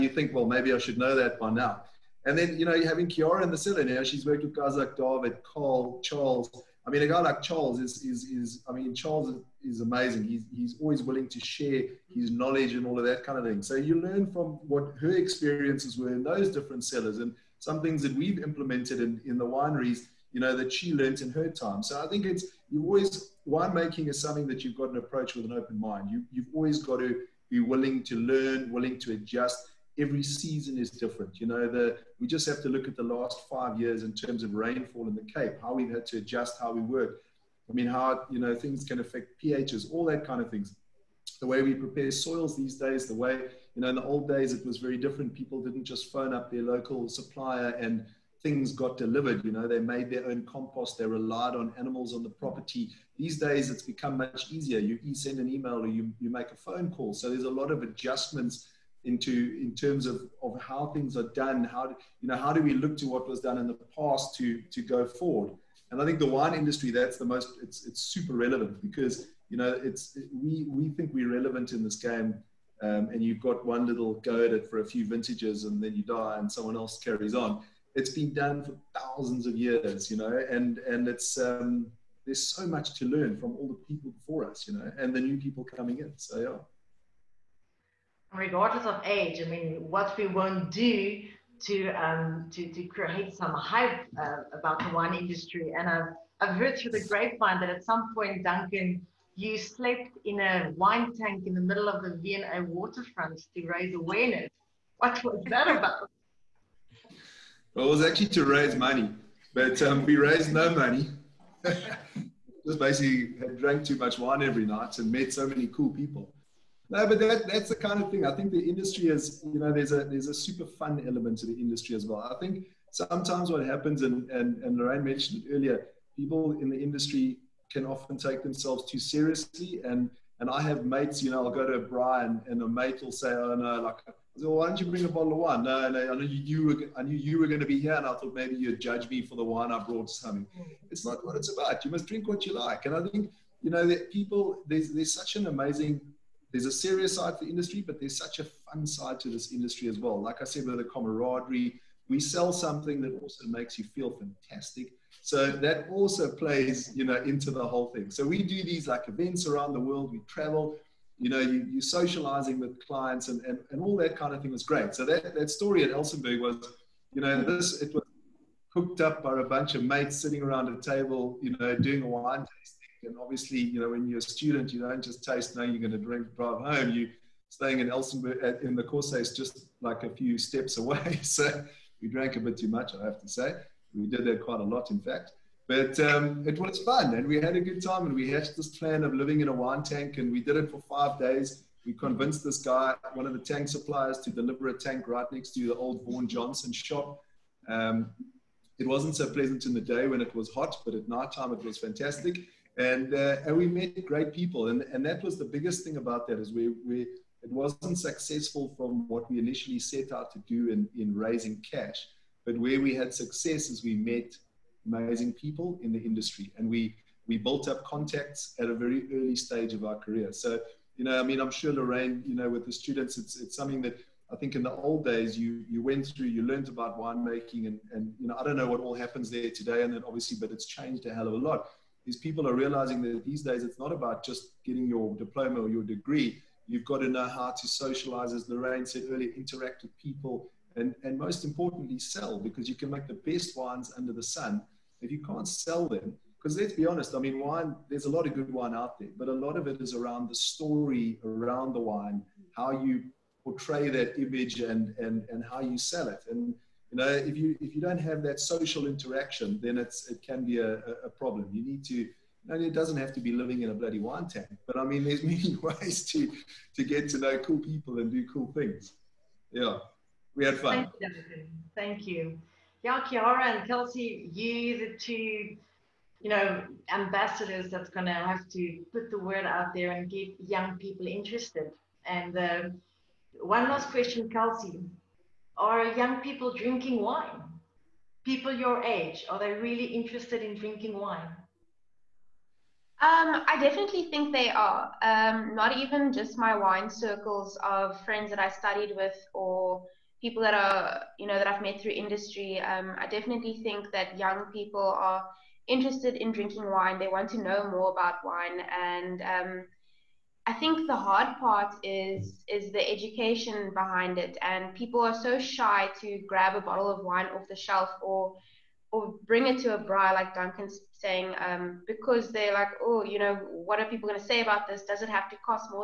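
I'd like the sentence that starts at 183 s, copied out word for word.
We did that quite a lot, in fact.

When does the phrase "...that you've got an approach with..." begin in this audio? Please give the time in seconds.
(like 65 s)
24 s.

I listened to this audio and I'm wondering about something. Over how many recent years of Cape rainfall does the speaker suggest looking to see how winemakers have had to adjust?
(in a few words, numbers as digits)
5.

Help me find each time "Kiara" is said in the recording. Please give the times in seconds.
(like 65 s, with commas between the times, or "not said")
3 s, 273 s.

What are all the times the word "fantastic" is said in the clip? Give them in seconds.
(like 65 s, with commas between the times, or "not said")
154 s, 201 s.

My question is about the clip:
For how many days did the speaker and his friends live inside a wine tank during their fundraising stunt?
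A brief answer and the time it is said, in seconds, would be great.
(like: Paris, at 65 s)
5, at 190 s.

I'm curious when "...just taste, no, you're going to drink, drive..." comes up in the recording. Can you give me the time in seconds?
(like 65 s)
175 s.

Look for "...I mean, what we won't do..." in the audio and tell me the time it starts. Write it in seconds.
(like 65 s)
89 s.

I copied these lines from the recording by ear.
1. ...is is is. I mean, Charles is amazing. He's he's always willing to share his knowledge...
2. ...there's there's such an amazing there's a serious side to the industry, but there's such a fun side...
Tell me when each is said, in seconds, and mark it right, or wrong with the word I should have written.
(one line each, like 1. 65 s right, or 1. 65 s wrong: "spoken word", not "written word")
1. 7 s right
2. 144 s right.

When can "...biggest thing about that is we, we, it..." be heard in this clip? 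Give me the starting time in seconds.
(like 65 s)
205 s.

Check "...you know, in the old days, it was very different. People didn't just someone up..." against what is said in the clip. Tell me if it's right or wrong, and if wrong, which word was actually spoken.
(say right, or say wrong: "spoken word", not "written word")
wrong: "phone", not "someone".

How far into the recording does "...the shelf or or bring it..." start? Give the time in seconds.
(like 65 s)
317 s.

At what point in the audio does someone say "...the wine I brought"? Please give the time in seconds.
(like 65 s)
139 s.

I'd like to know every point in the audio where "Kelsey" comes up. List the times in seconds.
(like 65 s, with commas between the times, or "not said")
273 s, 284 s.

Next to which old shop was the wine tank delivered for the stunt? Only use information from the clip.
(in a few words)
Vaughan Johnson.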